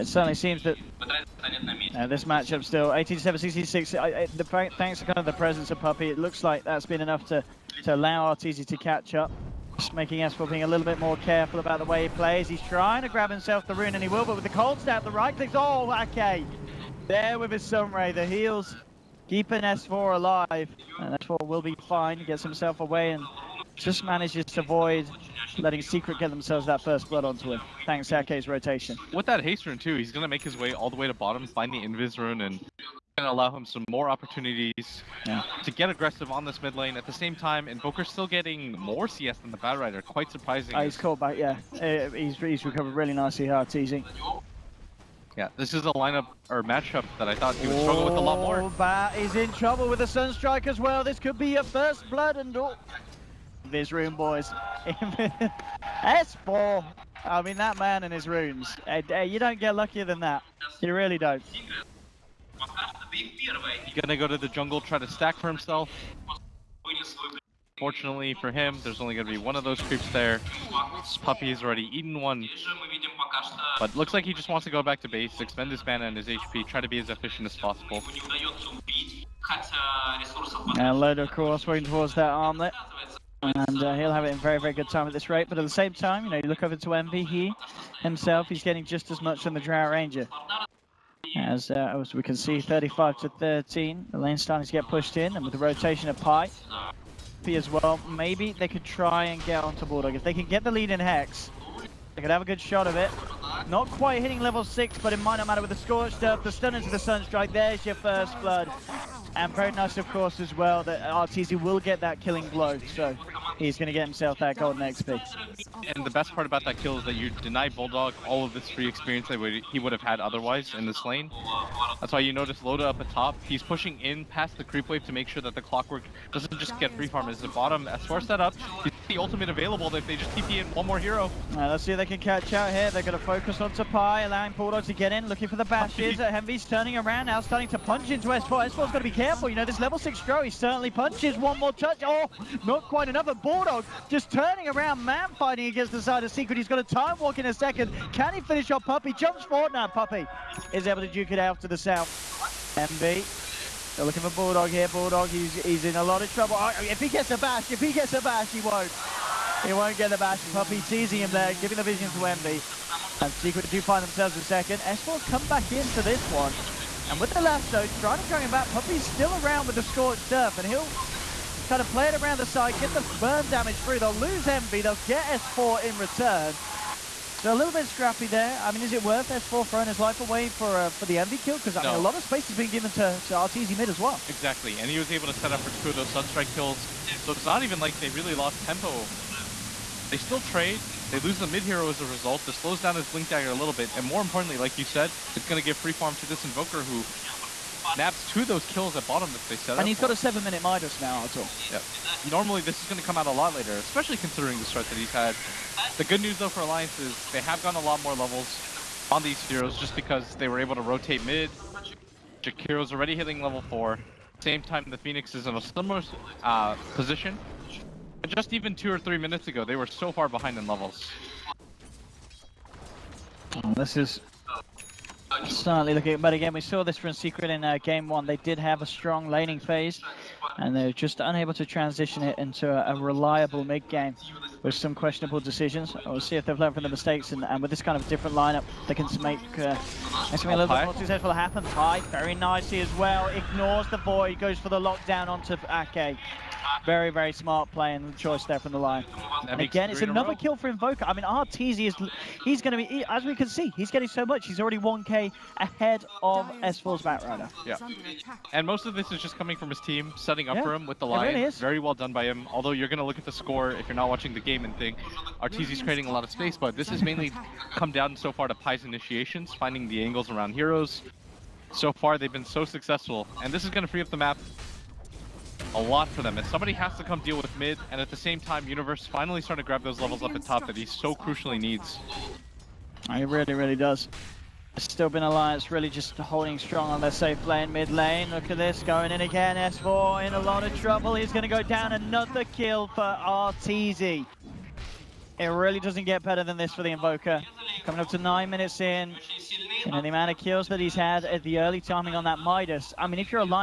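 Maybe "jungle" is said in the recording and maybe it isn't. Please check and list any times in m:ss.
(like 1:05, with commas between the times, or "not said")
1:04.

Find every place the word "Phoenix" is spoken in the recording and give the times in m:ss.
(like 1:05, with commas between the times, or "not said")
3:34.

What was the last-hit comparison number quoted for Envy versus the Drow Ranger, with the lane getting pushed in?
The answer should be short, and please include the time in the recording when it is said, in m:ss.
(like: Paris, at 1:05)
35 to 13, at 1:32.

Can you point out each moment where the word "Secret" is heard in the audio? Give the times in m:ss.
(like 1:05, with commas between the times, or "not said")
0:25, 2:26, 2:43, 3:47.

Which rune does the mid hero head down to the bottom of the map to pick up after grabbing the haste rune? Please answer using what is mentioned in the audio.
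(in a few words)
Invis rune.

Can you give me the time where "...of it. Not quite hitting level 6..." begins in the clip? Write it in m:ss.
1:42.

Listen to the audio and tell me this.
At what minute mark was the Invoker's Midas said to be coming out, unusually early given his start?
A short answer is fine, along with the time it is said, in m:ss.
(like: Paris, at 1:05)
7 minutes, at 3:20.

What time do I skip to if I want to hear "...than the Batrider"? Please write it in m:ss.
0:39.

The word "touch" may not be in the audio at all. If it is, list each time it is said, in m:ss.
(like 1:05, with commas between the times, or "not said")
2:21.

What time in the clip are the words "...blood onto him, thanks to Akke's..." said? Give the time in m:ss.
0:27.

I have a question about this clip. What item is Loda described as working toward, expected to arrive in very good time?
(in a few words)
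Armlet.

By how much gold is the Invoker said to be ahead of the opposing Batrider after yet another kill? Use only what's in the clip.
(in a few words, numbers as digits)
1k.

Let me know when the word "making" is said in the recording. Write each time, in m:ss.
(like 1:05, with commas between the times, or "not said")
0:09.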